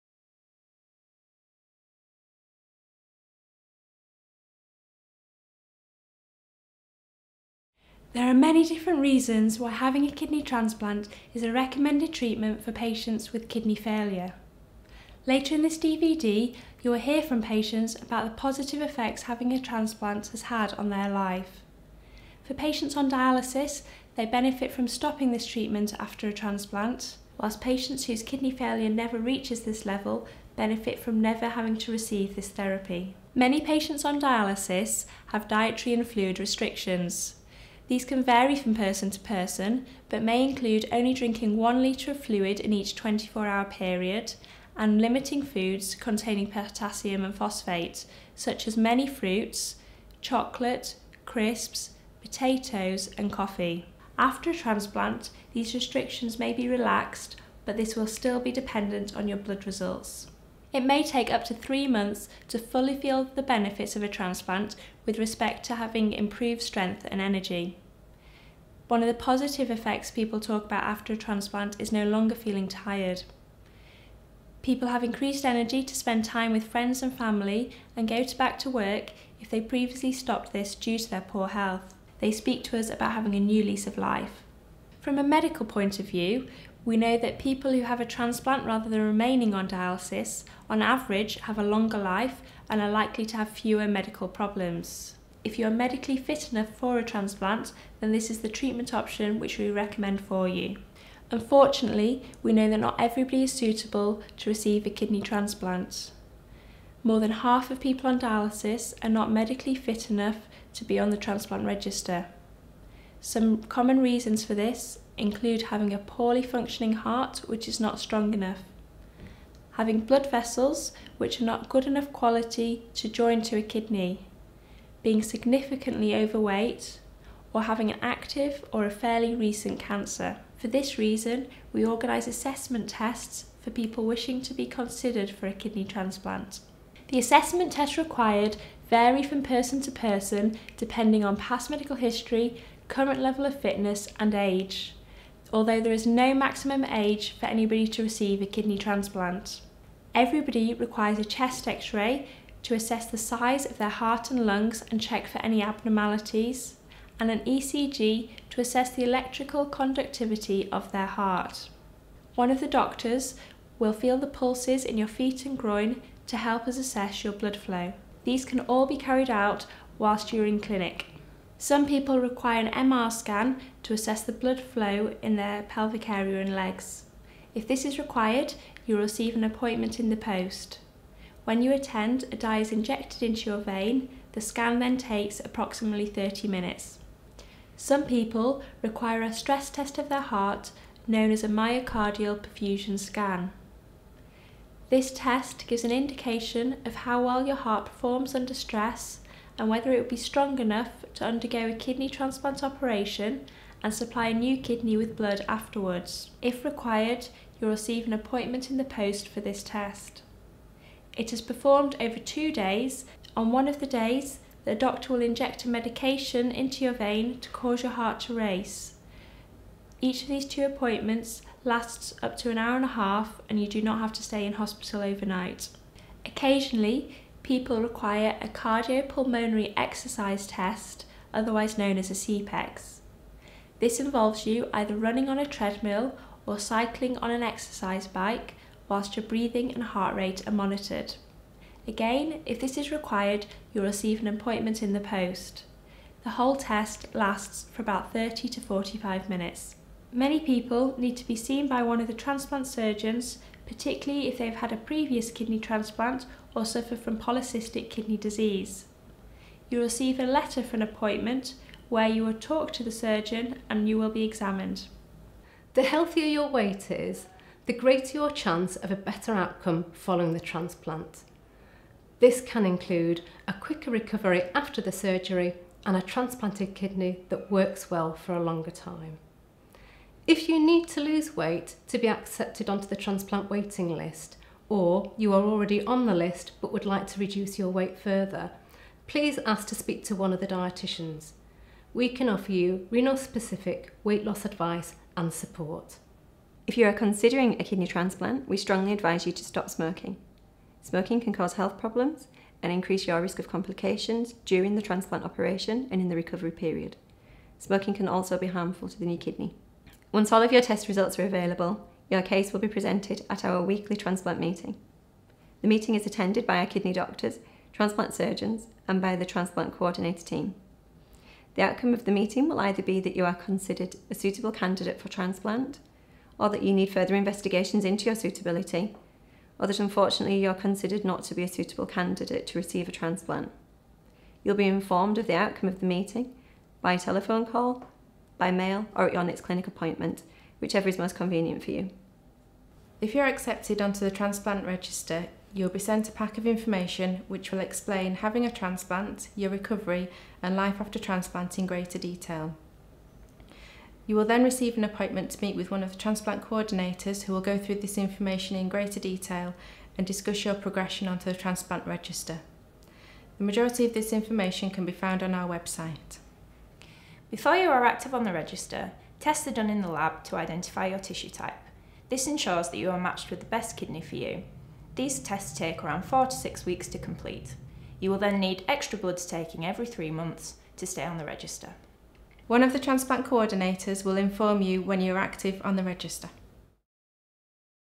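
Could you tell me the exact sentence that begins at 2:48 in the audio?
These can all be carried out whilst you're in clinic.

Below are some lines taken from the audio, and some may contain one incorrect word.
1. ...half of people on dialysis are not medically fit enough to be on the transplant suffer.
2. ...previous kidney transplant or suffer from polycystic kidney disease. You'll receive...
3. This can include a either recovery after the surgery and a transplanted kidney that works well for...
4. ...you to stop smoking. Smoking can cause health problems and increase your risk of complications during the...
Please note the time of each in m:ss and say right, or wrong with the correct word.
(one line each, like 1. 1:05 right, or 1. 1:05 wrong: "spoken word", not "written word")
1. 1:47 wrong: "register", not "suffer"
2. 4:14 right
3. 4:32 wrong: "quicker", not "either"
4. 4:59 right.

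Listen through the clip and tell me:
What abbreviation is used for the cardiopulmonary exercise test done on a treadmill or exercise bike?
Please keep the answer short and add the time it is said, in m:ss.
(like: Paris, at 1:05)
CPEX, at 3:52.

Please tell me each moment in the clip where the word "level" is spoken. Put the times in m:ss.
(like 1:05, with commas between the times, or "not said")
0:29, 2:23.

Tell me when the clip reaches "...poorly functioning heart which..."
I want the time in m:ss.
1:55.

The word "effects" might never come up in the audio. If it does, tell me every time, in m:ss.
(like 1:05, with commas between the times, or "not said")
0:18, 1:09.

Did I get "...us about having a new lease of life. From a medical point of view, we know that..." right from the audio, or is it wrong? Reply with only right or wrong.
right.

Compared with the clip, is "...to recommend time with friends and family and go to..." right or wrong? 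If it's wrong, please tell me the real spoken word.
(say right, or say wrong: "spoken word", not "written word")
wrong: "spend", not "recommend".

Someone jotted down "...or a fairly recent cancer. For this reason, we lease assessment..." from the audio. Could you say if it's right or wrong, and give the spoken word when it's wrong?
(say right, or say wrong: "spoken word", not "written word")
wrong: "organise", not "lease".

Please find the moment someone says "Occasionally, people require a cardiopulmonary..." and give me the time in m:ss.
3:46.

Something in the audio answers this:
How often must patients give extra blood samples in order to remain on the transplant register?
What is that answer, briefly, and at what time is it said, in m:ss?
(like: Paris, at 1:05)
every 3 months, at 6:19.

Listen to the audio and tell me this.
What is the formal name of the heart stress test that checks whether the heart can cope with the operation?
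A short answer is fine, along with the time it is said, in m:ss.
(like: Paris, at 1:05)
myocardial perfusion scan, at 3:11.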